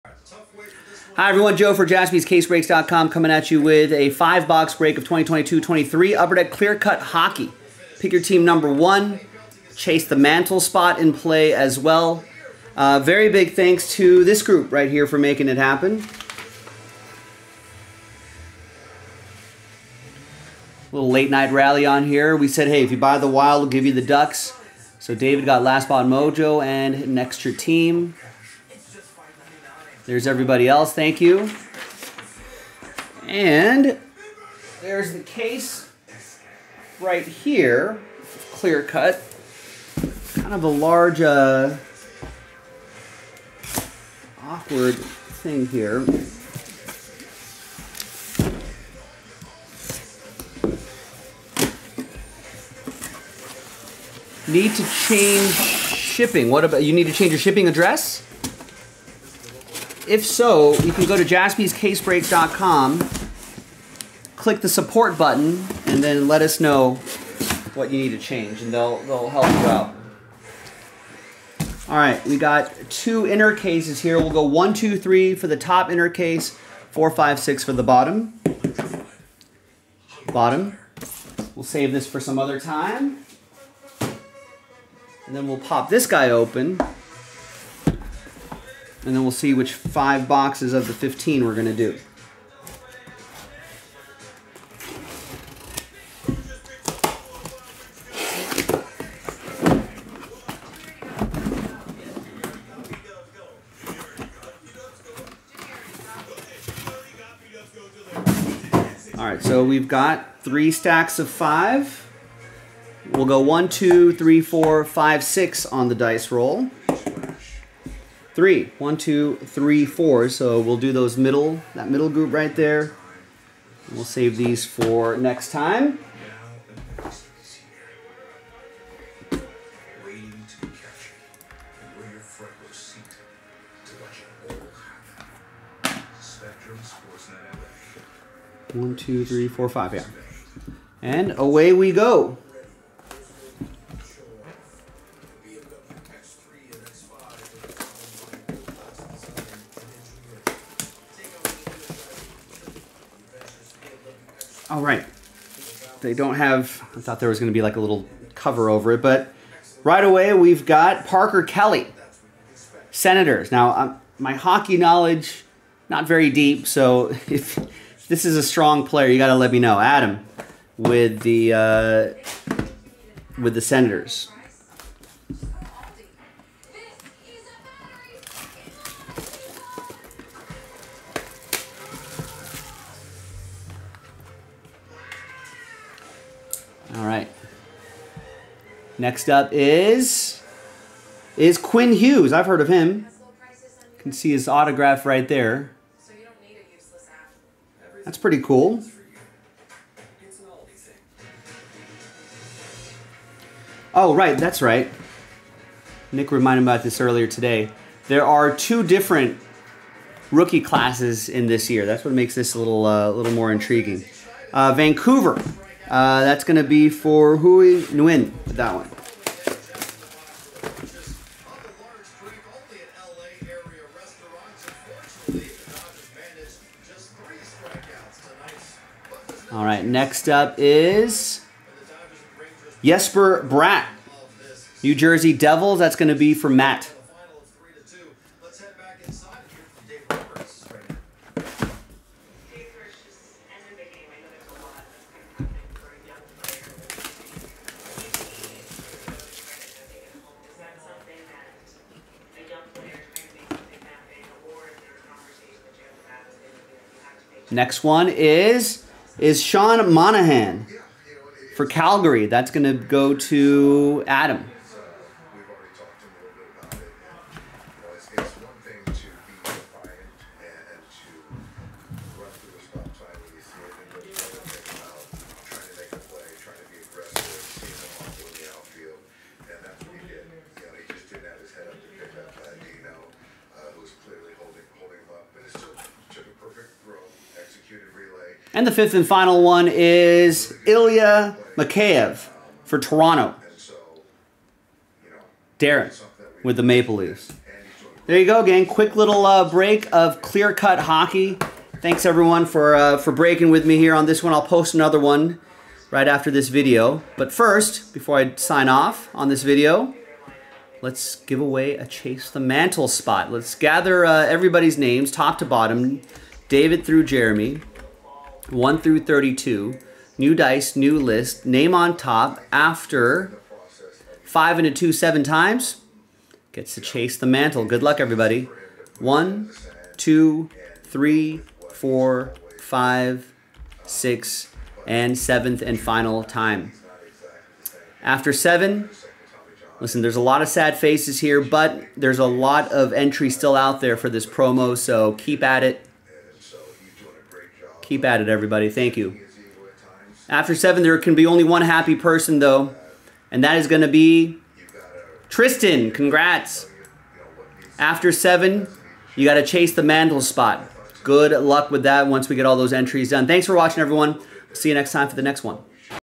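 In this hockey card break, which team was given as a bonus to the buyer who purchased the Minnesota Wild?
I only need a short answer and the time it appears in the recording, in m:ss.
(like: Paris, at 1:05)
Ducks, at 0:24.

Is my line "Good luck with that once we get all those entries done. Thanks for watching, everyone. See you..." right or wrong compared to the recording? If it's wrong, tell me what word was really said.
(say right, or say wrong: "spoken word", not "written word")
right.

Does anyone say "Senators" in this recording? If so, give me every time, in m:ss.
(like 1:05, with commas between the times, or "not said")
2:42, 2:53.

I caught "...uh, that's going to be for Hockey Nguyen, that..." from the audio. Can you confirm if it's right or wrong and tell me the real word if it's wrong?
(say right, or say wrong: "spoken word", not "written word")
wrong: "Hui", not "Hockey".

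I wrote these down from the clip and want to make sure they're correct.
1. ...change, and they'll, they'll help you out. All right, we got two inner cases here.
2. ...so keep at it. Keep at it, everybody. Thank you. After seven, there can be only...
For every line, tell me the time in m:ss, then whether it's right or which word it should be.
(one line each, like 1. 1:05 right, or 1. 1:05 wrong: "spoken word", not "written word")
1. 1:08 right
2. 5:44 right.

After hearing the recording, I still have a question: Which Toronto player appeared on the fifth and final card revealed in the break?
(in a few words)
Ilya Mikheyev.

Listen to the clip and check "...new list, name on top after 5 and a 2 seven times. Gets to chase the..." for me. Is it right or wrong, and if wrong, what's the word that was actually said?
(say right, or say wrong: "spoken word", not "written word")
right.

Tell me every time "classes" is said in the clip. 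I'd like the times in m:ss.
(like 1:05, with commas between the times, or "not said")
3:30.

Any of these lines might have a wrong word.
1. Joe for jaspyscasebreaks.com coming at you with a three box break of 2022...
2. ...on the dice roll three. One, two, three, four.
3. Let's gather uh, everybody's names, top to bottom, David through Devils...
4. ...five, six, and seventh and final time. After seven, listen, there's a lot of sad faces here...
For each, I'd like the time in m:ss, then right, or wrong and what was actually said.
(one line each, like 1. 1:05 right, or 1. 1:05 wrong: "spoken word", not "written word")
1. 0:01 wrong: "five", not "three"
2. 1:55 right
3. 5:13 wrong: "Jeremy", not "Devils"
4. 5:32 right.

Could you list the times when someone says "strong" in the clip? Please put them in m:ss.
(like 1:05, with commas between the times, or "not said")
2:48.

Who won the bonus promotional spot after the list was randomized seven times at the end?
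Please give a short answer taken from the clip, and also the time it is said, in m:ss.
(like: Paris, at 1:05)
Tristan, at 5:55.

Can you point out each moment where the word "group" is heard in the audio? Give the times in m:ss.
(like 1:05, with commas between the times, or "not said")
0:14, 2:02.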